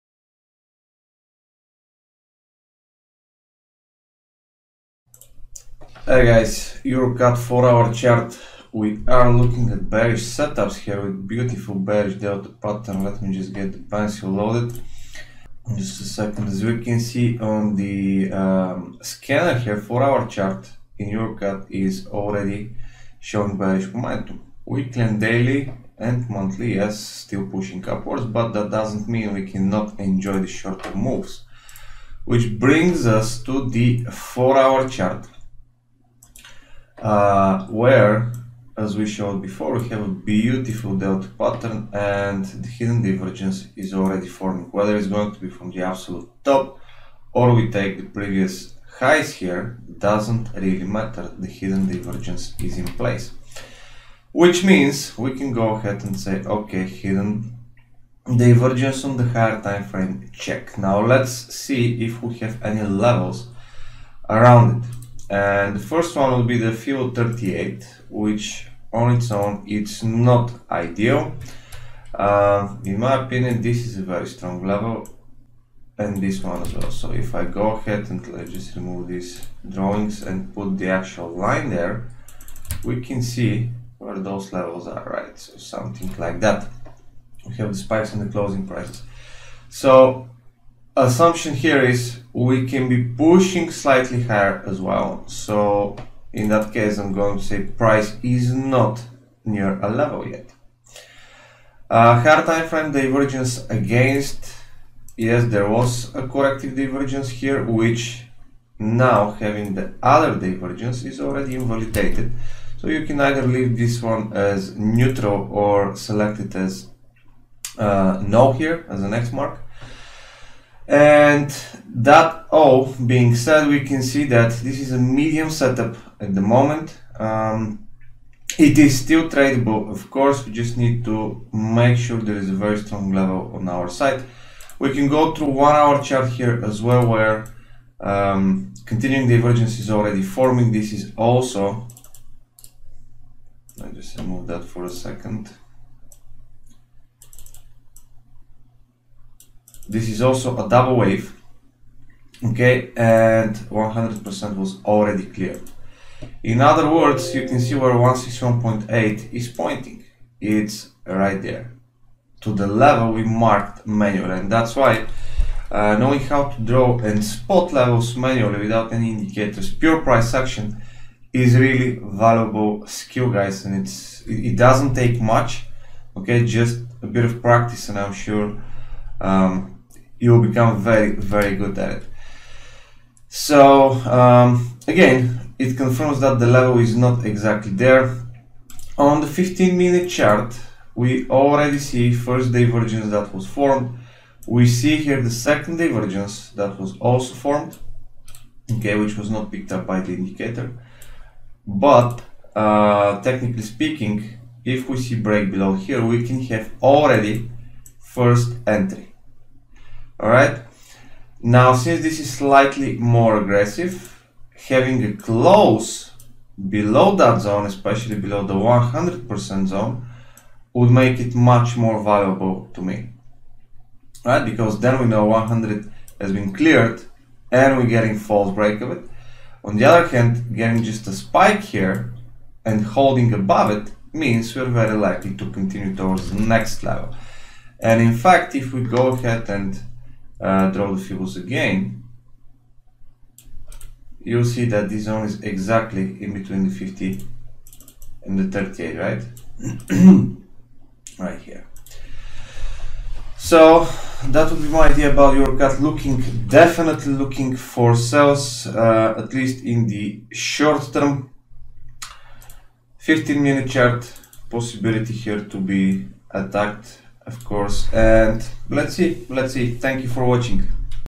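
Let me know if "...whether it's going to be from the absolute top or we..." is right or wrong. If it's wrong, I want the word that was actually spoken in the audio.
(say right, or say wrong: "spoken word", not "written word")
right.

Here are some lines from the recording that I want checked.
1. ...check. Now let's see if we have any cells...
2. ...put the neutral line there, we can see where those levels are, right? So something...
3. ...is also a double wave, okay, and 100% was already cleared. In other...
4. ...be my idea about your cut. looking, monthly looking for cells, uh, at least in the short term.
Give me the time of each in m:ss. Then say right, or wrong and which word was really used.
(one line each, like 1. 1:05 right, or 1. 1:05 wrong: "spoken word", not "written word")
1. 1:00 wrong: "levels", not "cells"
2. 1:20 wrong: "actual", not "neutral"
3. 2:30 right
4. 4:14 wrong: "definitely", not "monthly".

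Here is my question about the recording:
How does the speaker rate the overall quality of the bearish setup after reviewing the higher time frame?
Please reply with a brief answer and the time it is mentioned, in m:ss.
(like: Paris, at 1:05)
medium, at 2:04.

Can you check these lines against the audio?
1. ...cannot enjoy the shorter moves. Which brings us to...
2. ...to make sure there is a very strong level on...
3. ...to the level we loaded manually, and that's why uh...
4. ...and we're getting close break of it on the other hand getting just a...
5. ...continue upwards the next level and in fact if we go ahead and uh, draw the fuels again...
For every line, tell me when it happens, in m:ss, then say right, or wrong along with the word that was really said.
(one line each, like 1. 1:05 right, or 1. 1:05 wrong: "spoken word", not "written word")
1. 0:29 right
2. 2:11 right
3. 2:42 wrong: "marked", not "loaded"
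4. 3:47 wrong: "false", not "close"
5. 3:55 wrong: "towards", not "upwards".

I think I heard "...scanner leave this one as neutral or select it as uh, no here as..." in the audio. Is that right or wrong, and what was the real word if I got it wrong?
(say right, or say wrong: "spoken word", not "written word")
wrong: "either", not "scanner".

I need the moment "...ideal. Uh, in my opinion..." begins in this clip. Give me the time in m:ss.
1:10.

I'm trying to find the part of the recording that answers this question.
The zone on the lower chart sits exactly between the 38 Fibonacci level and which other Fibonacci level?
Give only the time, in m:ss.
4:06.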